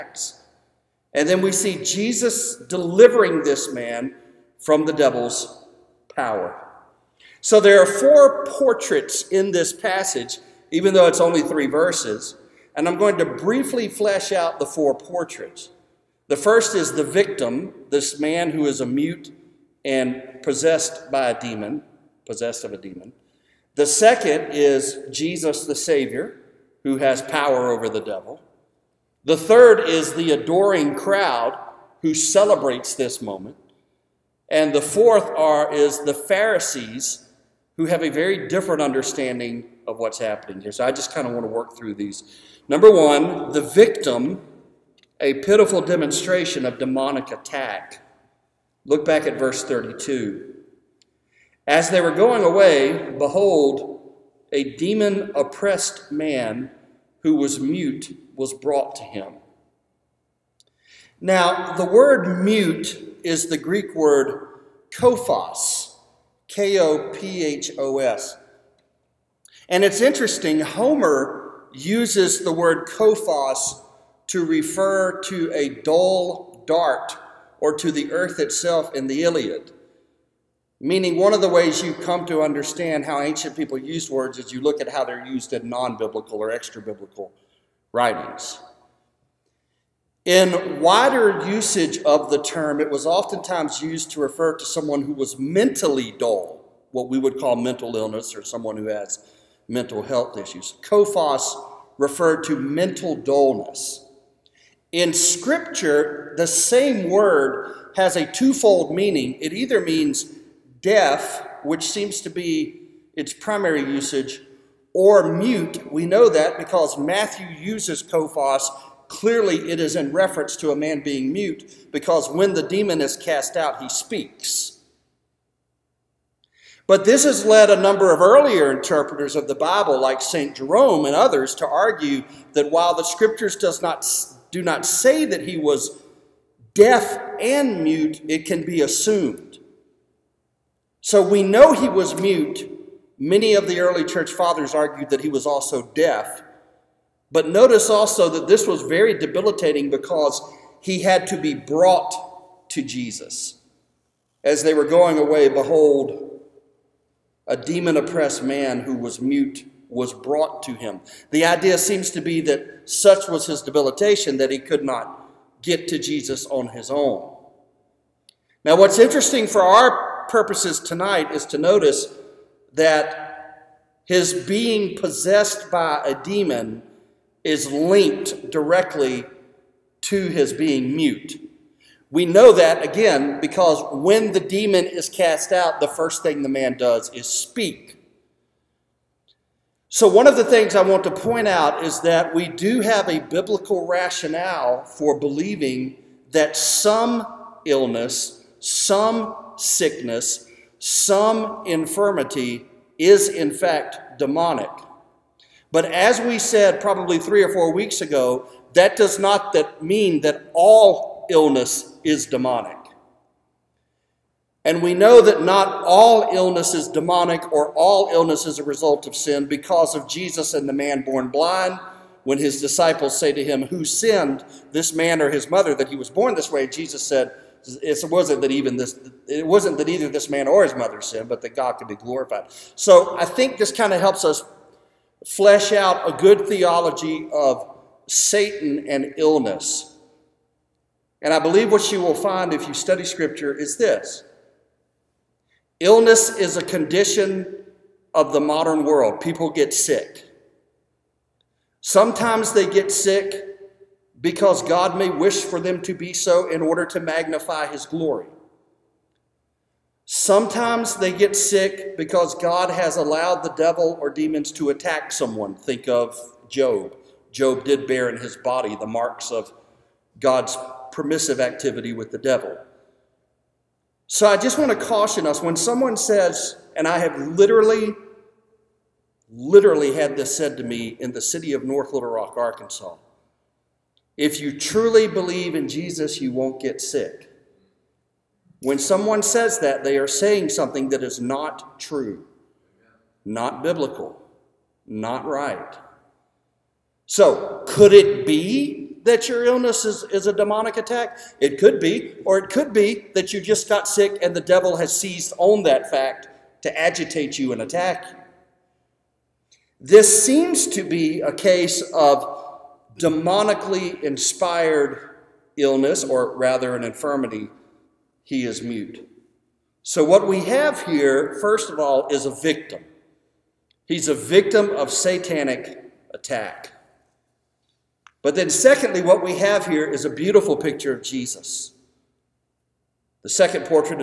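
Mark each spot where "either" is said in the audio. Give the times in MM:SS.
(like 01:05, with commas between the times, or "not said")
01:49, 03:49.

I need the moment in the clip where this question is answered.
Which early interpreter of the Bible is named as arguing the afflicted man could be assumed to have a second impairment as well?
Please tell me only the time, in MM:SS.
02:10.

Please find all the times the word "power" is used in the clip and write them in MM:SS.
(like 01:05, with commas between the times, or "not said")
00:06, 00:27.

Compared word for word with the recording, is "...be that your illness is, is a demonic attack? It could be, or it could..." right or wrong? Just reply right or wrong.
right.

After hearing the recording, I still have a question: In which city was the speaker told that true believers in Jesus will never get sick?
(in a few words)
North Little Rock.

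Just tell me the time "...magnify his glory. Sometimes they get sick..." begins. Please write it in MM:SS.
04:17.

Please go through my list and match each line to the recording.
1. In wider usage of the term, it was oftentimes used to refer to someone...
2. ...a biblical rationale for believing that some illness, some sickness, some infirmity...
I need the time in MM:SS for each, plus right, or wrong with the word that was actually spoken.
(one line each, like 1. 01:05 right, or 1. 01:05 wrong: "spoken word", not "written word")
1. 01:30 right
2. 03:13 right.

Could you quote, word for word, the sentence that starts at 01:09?
And it's interesting, Homer uses the word kophos to refer to a dull dart or to the earth itself in the Iliad.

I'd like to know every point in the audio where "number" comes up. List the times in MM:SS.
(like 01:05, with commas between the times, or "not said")
00:42, 02:07.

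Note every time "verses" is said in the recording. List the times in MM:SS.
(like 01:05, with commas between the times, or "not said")
00:11, 00:49.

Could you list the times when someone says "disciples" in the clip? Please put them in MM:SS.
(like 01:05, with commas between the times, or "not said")
03:42.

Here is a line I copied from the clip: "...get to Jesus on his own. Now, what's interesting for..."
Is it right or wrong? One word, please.
right.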